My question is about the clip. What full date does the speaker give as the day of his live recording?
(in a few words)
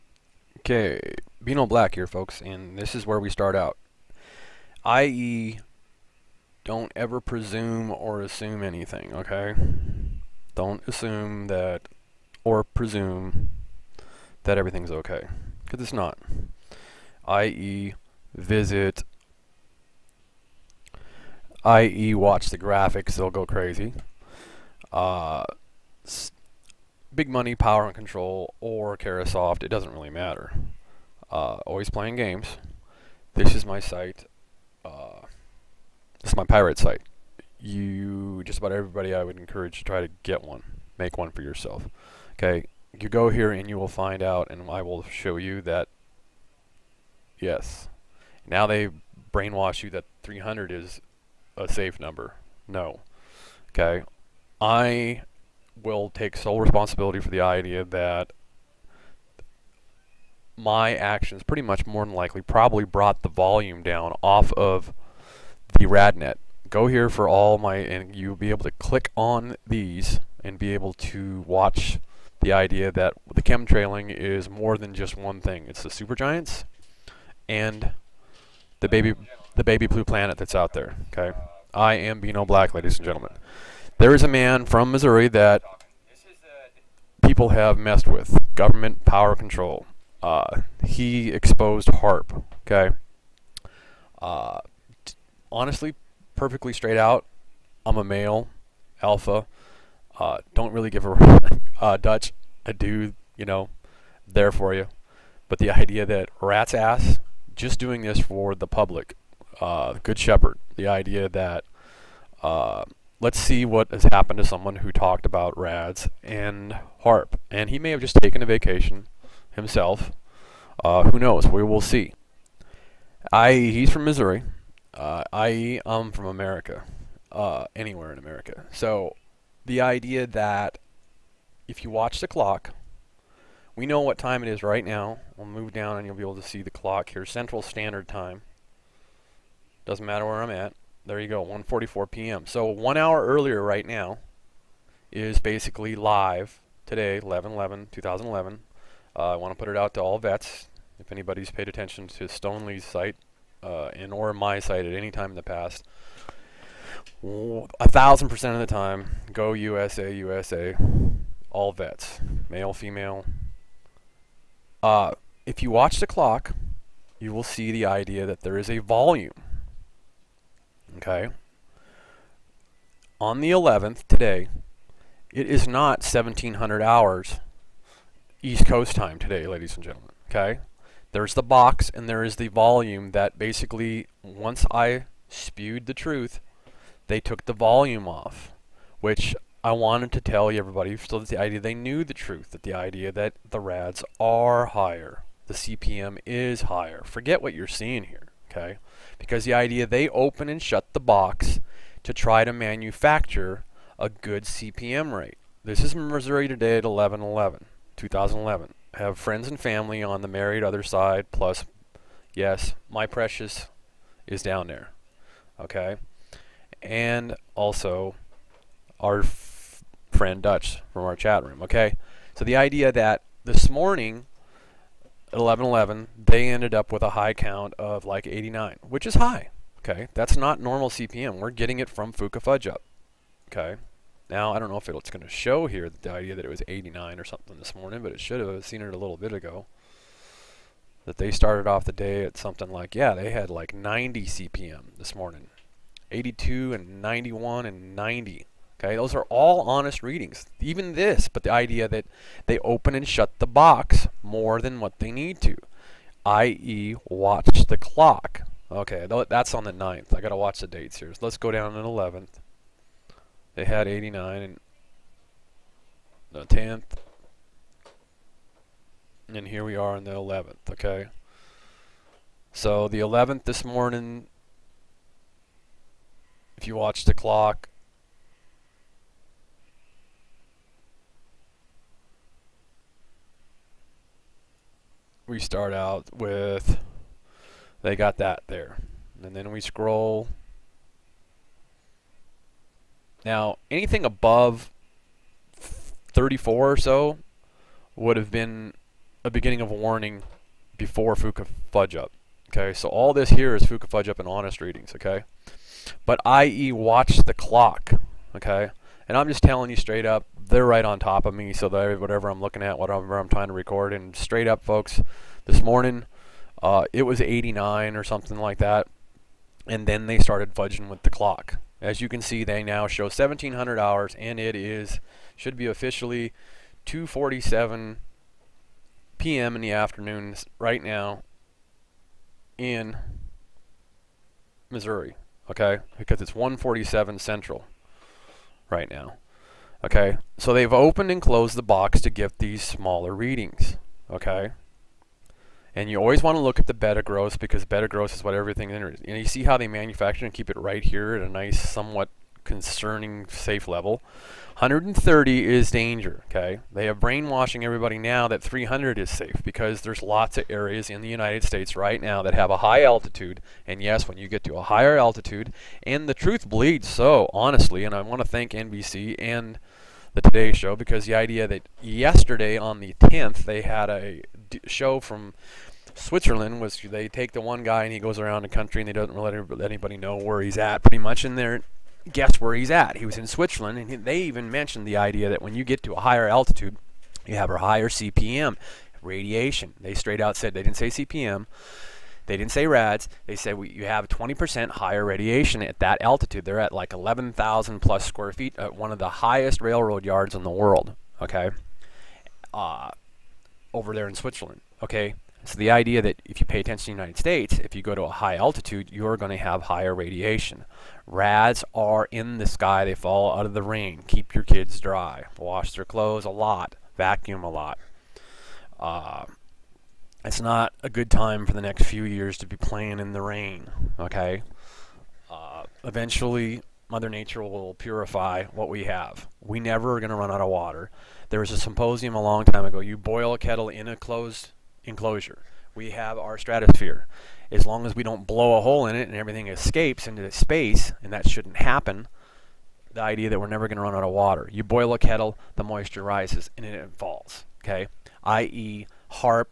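11/11/2011.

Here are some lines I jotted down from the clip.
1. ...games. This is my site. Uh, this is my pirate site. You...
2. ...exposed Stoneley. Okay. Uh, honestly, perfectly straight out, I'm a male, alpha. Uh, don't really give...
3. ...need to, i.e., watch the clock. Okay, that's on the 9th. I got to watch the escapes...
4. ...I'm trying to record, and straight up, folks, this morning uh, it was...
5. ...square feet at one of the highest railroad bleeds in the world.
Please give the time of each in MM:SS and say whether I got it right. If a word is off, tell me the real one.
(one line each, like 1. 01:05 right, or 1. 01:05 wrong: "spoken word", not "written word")
1. 00:32 right
2. 01:31 wrong: "HAARP", not "Stoneley"
3. 04:15 wrong: "dates", not "escapes"
4. 05:13 right
5. 06:38 wrong: "yards", not "bleeds".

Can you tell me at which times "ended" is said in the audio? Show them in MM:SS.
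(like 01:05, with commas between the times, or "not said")
03:46.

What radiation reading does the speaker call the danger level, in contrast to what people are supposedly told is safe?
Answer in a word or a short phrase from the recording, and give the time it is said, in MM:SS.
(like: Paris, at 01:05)
130, at 05:54.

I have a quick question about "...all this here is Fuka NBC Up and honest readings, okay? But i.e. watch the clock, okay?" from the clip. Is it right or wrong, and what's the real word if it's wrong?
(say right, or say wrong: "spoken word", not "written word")
wrong: "Fudge", not "NBC".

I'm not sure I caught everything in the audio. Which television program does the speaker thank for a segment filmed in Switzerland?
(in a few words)
The Today Show.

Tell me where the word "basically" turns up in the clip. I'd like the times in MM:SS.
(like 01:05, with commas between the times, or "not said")
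02:25, 03:03.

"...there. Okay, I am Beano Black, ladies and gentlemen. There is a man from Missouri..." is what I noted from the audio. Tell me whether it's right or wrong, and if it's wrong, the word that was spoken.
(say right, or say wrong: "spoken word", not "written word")
right.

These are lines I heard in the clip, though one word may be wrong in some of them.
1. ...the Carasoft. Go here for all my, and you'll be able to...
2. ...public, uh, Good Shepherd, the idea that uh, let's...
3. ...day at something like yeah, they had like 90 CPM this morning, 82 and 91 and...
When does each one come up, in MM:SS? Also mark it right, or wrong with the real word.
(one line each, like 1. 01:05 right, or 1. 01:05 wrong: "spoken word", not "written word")
1. 01:05 wrong: "RadNet", not "Carasoft"
2. 01:48 right
3. 04:01 right.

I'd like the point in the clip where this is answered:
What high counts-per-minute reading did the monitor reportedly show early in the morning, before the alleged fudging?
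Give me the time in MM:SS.
03:47.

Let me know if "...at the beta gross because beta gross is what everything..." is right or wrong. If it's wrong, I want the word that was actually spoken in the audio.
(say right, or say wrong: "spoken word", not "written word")
right.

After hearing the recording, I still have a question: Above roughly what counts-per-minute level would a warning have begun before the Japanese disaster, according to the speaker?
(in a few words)
34.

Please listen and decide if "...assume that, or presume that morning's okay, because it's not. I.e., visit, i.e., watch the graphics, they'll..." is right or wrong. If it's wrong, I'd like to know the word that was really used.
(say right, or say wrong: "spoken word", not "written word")
wrong: "everything", not "morning".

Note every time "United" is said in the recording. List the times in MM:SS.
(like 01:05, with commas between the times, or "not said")
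06:01, 06:47.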